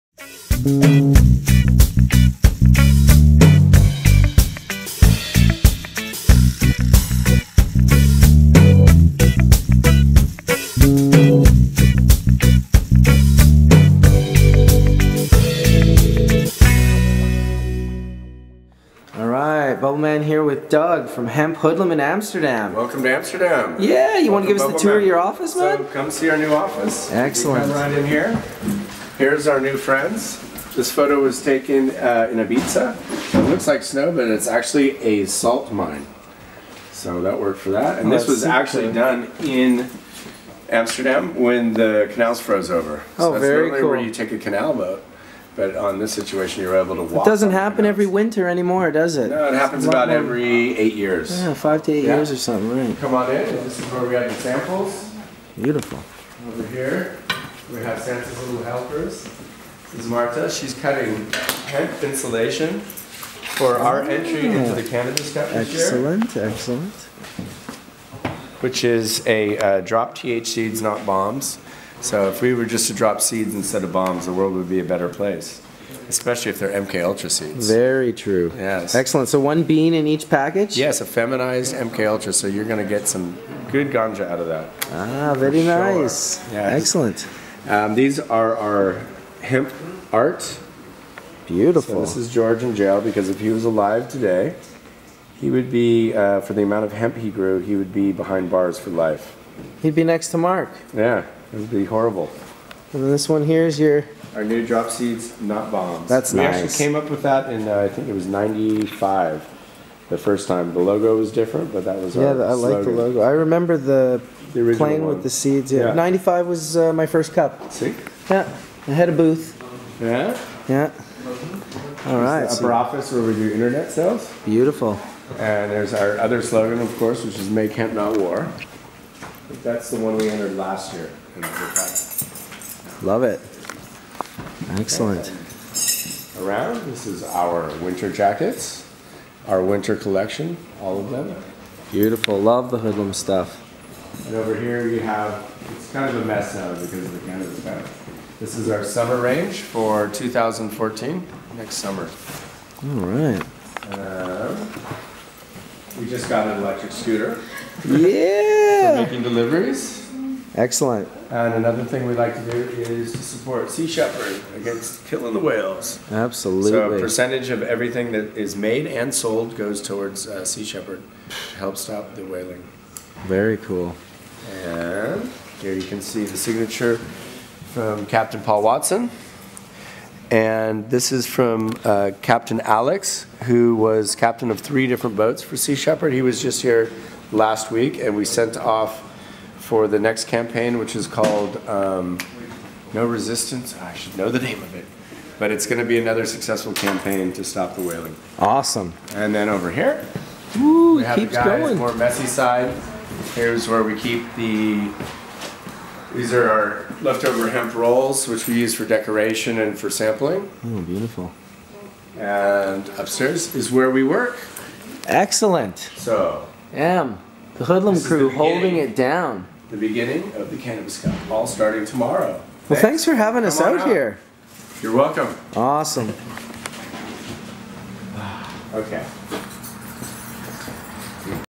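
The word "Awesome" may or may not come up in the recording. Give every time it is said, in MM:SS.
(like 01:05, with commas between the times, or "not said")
03:18, 03:45.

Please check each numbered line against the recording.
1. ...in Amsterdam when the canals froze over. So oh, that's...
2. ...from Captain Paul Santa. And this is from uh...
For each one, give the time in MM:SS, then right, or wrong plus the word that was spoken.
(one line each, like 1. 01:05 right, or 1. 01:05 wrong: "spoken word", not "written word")
1. 00:39 right
2. 02:57 wrong: "Watson", not "Santa".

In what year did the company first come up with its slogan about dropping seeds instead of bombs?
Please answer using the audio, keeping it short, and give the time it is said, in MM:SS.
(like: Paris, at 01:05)
1995, at 01:48.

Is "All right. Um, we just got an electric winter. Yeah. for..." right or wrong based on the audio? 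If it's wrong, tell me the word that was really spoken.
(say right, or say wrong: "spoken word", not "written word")
wrong: "scooter", not "winter".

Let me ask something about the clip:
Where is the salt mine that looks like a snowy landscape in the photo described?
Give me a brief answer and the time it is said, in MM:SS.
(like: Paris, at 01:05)
Ibiza, at 00:32.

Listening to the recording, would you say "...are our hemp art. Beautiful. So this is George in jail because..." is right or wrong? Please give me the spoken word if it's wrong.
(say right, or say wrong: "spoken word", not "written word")
right.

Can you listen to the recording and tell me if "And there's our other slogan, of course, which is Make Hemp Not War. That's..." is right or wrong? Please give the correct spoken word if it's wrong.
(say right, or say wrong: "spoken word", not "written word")
right.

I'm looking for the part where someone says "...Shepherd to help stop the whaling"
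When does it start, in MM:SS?
02:50.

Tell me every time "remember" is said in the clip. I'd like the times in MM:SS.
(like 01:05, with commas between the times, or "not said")
01:53.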